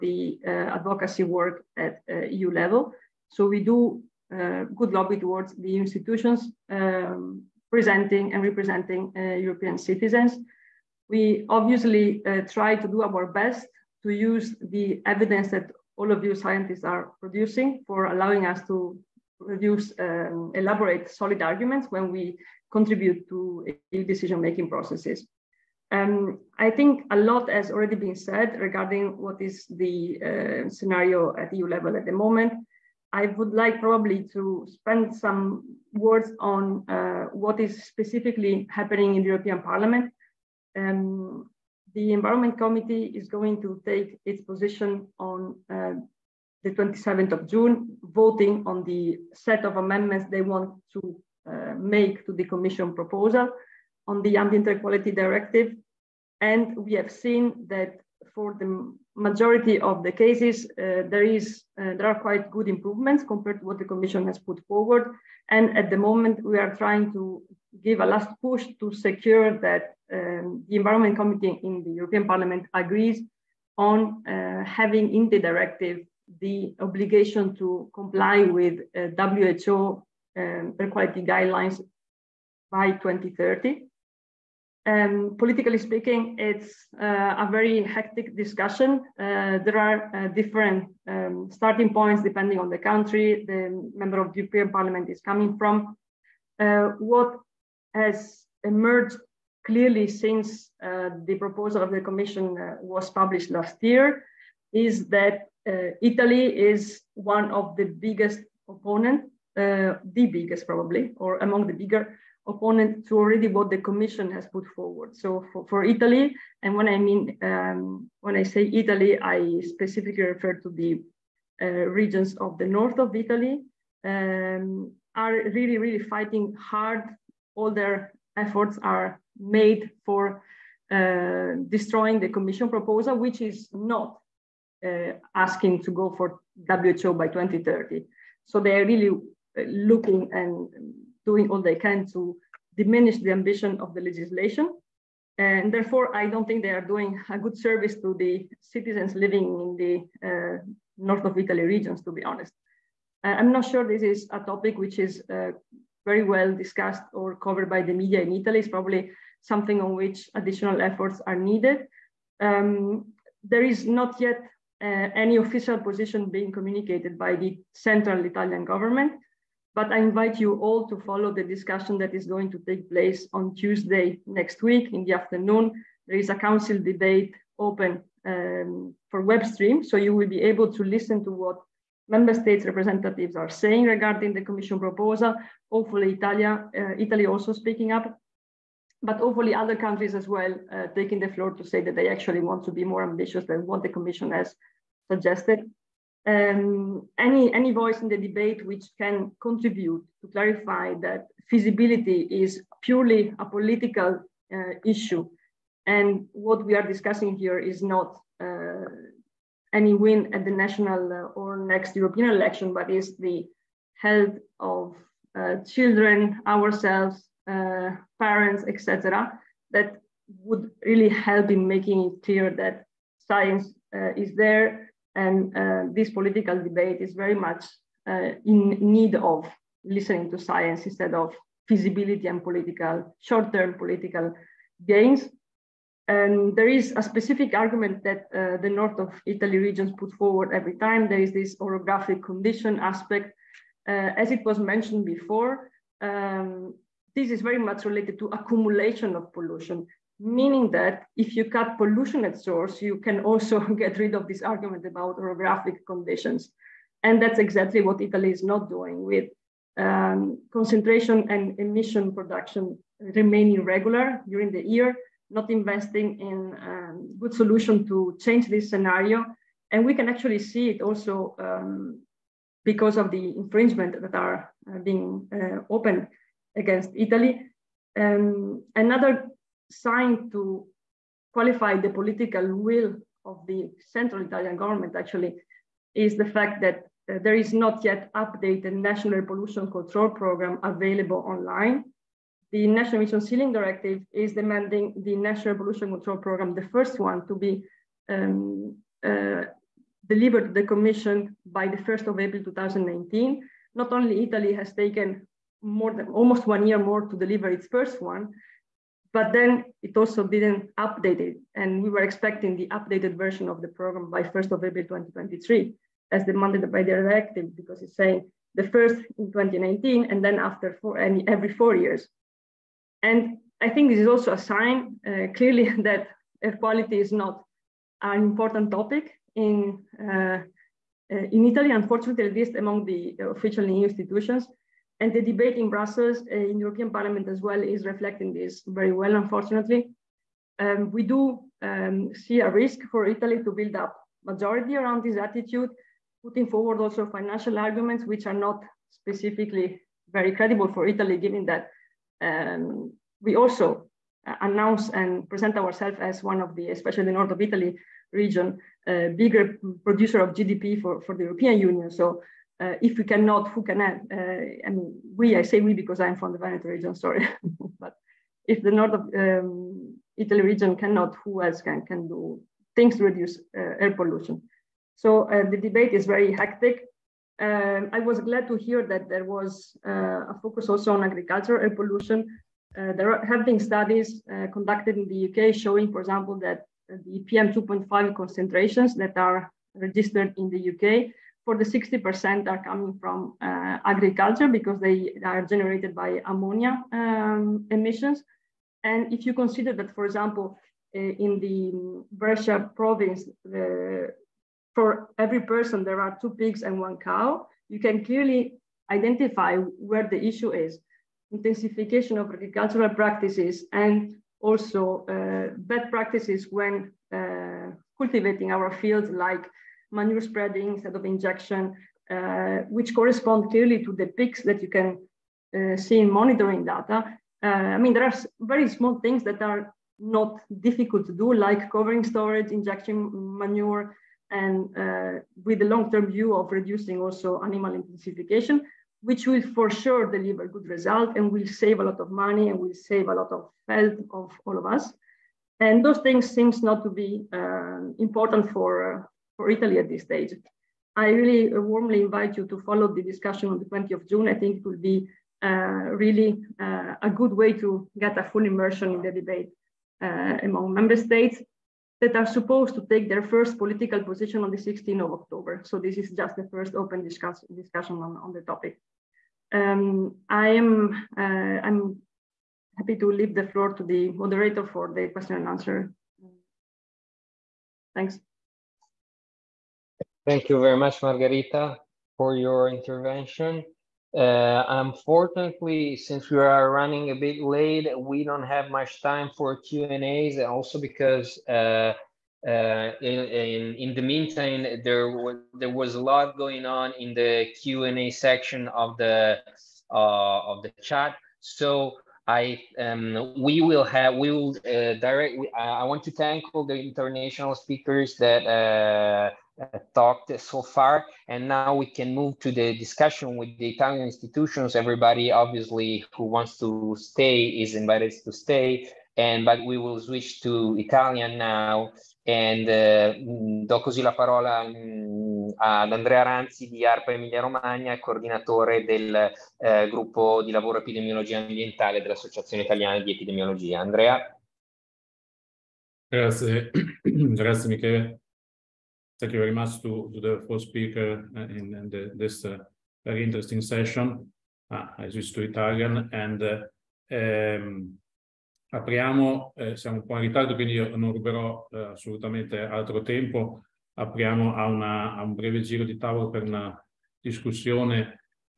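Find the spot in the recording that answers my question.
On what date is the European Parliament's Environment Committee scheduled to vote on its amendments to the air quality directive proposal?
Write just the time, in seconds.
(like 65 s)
46 s.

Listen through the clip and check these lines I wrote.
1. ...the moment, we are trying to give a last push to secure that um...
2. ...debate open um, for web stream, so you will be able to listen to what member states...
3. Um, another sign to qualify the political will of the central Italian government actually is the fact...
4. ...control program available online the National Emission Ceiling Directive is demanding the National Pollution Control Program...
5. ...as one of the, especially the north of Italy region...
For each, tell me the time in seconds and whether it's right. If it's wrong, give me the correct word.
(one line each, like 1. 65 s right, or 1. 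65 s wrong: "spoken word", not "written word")
1. 65 s right
2. 176 s right
3. 277 s right
4. 289 s right
5. 356 s right.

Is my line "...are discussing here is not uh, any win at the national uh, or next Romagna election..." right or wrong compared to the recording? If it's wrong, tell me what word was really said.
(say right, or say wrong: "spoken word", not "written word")
wrong: "European", not "Romagna".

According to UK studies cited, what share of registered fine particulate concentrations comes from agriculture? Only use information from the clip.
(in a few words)
60%.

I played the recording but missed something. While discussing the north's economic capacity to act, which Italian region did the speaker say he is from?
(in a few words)
Veneto.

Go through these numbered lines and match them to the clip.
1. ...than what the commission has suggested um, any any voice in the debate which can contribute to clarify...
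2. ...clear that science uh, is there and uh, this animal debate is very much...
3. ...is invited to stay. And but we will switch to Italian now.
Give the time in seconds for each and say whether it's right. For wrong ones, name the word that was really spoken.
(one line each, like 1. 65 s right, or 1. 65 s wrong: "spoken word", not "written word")
1. 193 s right
2. 222 s wrong: "political", not "animal"
3. 517 s right.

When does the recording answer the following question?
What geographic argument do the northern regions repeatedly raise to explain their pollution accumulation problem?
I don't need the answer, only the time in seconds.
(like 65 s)
241 s.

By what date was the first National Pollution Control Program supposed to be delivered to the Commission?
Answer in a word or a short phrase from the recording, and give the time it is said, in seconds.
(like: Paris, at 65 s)
1st of April 2019, at 301 s.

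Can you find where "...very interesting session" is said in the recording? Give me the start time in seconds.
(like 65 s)
543 s.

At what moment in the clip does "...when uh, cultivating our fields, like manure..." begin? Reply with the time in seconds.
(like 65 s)
416 s.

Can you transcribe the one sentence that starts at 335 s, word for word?
And the debate in Brussels, in European Parliament as well, is reflecting this very well, unfortunately.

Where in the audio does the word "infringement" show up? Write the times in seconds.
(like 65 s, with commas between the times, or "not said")
273 s.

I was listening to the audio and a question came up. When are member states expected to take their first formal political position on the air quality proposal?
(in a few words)
16th of October.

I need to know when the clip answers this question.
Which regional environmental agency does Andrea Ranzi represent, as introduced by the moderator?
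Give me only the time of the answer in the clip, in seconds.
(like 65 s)
526 s.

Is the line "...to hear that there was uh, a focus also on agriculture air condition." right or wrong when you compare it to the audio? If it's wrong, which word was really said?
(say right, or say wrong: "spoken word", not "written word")
wrong: "pollution", not "condition".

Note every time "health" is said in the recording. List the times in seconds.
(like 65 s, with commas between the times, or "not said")
214 s, 443 s.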